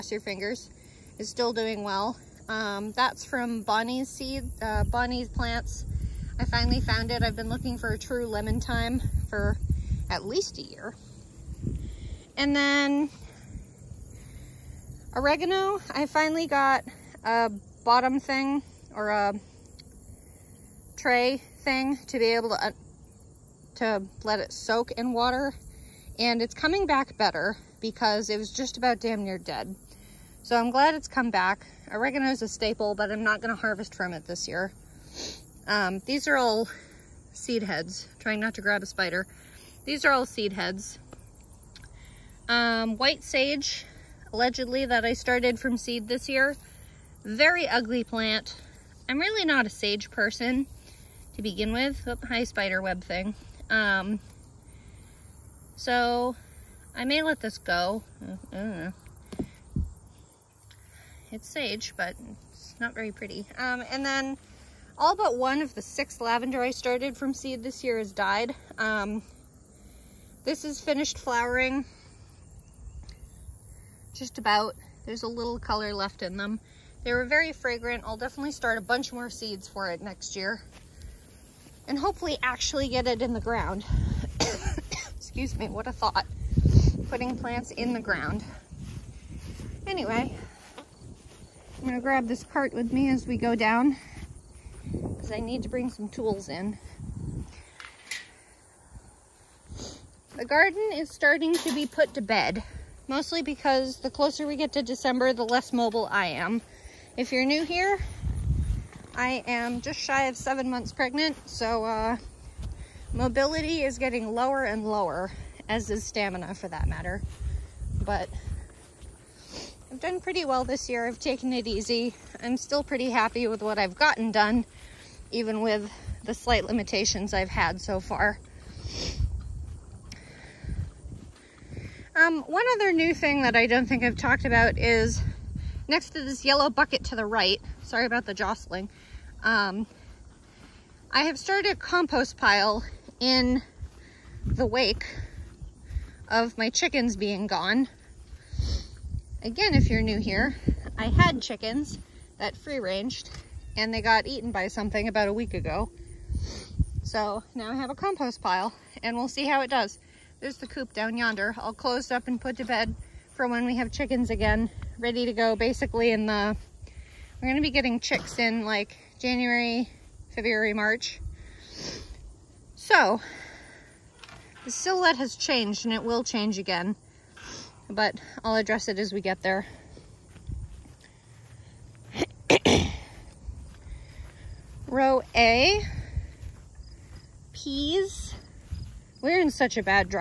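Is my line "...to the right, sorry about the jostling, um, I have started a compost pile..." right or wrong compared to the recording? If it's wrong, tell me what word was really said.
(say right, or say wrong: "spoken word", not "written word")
right.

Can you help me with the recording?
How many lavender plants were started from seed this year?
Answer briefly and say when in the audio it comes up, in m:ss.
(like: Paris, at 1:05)
6, at 1:05.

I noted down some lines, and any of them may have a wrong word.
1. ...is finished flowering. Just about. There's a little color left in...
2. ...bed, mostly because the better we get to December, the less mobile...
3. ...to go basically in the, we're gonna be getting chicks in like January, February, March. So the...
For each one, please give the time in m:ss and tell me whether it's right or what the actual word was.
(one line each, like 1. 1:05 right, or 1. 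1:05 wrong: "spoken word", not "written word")
1. 1:10 right
2. 1:42 wrong: "closer", not "better"
3. 2:45 right.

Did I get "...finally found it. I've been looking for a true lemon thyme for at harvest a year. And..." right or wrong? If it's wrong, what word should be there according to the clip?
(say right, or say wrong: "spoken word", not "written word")
wrong: "least", not "harvest".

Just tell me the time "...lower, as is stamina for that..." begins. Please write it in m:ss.
1:54.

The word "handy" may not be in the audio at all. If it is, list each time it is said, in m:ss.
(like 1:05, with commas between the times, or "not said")
not said.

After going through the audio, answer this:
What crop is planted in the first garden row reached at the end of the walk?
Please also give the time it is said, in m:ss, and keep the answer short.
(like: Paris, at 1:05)
Peas, at 3:07.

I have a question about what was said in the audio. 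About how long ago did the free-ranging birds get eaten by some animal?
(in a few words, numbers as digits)
a week ago.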